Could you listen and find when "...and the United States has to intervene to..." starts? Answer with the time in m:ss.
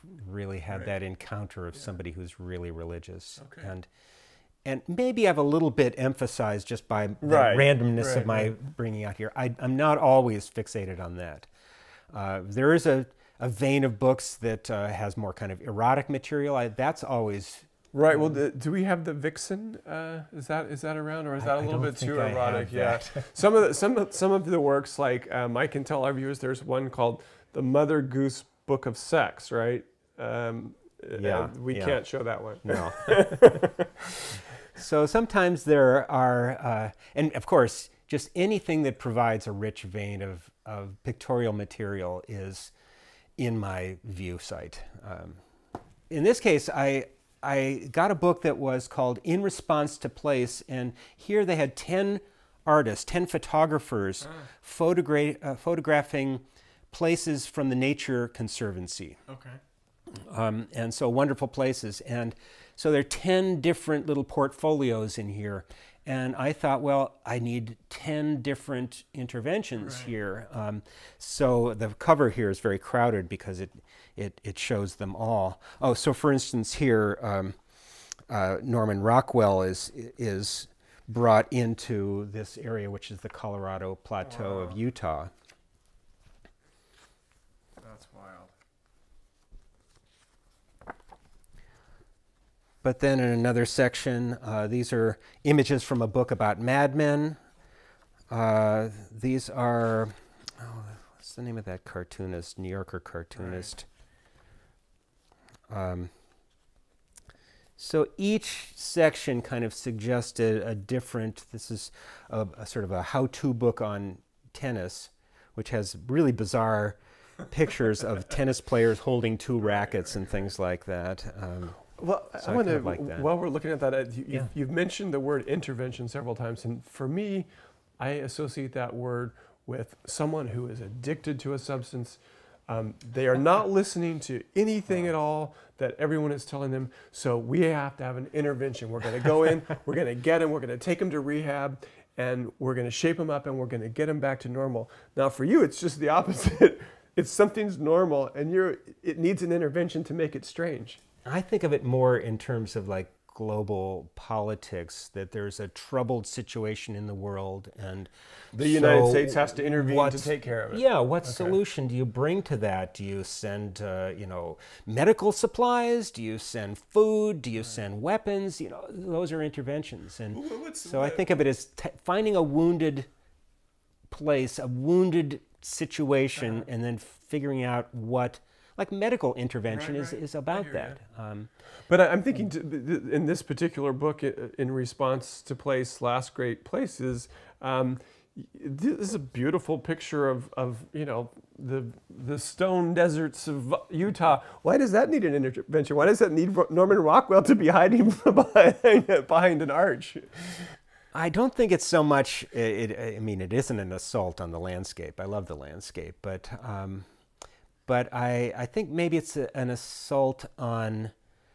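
2:37.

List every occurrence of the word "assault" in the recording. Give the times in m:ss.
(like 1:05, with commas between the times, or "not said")
3:23, 3:29.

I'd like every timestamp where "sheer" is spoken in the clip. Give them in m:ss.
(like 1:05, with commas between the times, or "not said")
not said.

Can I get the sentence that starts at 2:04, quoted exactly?
you've mentioned the word intervention several times.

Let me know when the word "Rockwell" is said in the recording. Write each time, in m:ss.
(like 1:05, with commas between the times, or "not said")
1:19, 3:16.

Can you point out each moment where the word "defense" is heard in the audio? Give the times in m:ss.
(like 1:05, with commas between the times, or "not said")
not said.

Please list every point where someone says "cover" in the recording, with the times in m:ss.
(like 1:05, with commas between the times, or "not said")
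1:11.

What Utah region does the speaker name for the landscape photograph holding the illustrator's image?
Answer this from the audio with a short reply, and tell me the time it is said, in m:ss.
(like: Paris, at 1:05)
Colorado Plateau, at 1:23.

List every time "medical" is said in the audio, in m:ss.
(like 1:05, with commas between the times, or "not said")
2:44, 2:58.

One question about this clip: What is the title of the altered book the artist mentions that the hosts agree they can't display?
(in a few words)
Mother Goose Book of Sex.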